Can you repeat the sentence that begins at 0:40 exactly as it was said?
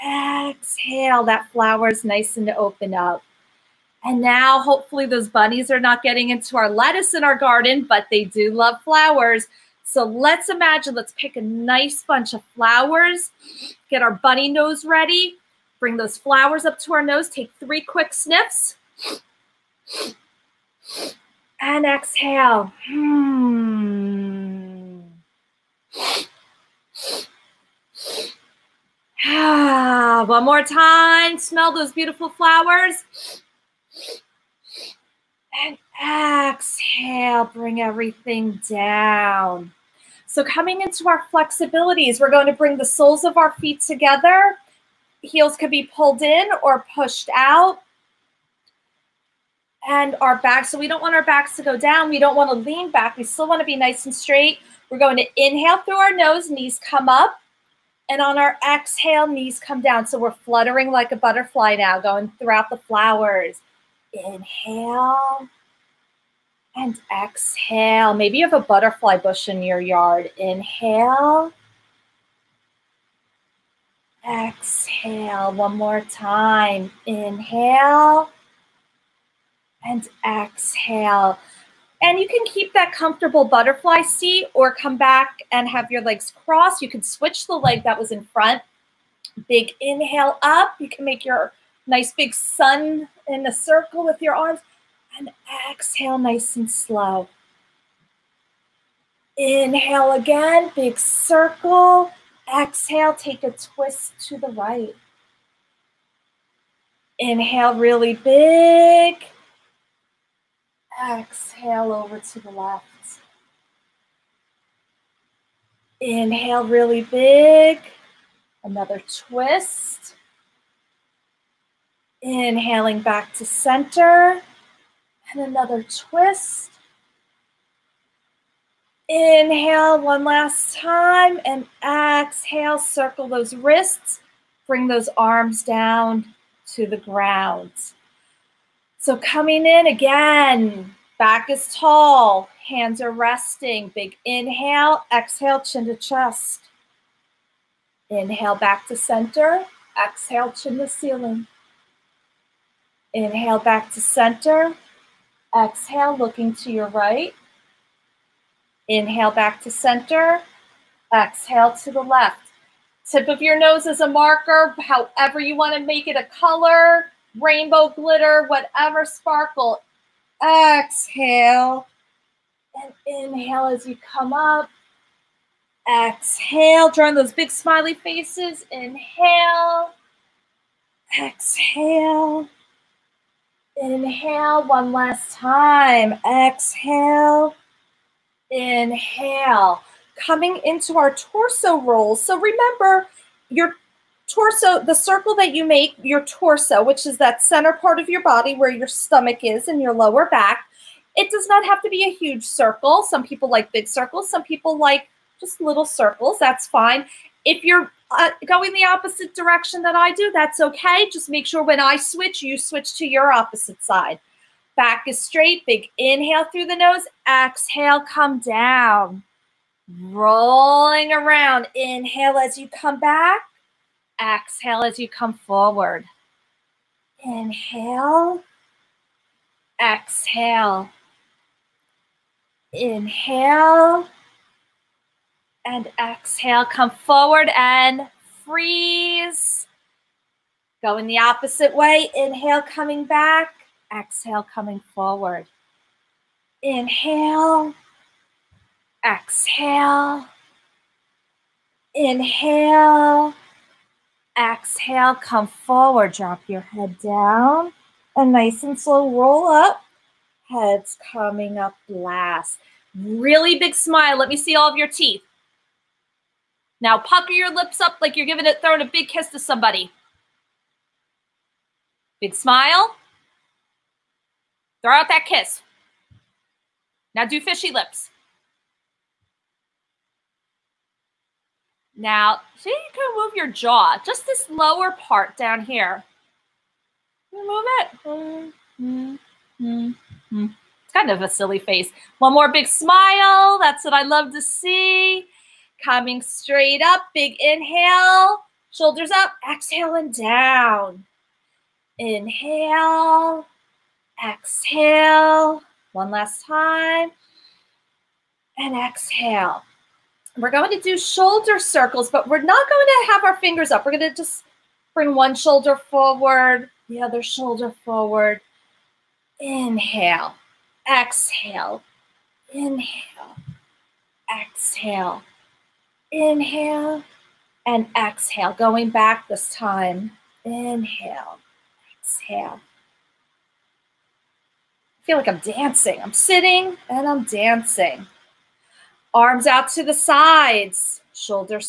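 So coming into our flexibilities, we're going to bring the soles of our feet together.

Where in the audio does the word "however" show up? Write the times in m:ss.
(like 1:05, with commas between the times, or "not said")
2:44.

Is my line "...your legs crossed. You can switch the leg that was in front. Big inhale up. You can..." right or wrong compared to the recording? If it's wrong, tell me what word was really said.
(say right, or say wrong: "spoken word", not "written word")
right.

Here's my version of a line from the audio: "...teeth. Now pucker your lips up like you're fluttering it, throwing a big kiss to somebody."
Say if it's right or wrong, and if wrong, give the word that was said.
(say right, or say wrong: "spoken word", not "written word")
wrong: "giving", not "fluttering".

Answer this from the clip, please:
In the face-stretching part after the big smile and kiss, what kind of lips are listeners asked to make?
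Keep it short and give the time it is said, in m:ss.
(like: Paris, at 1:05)
fishy lips, at 4:37.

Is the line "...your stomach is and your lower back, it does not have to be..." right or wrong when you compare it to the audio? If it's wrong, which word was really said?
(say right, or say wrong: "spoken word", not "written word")
right.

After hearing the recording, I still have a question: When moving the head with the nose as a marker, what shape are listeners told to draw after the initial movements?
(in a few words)
smiley faces.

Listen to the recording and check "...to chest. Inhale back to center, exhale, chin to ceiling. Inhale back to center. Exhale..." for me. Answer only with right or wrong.
right.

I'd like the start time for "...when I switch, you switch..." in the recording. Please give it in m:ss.
3:31.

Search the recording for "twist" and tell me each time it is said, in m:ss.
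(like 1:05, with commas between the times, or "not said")
1:43, 1:59, 2:05.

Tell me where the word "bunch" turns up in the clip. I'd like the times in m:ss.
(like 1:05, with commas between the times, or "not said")
0:12.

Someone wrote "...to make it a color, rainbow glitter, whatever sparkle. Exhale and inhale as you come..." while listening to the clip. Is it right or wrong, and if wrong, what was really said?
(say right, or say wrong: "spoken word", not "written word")
right.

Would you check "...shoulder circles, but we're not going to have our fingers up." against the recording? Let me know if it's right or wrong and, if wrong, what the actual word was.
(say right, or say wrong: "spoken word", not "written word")
right.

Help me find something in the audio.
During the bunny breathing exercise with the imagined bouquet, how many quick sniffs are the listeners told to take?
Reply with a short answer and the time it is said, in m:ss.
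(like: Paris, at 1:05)
3, at 0:17.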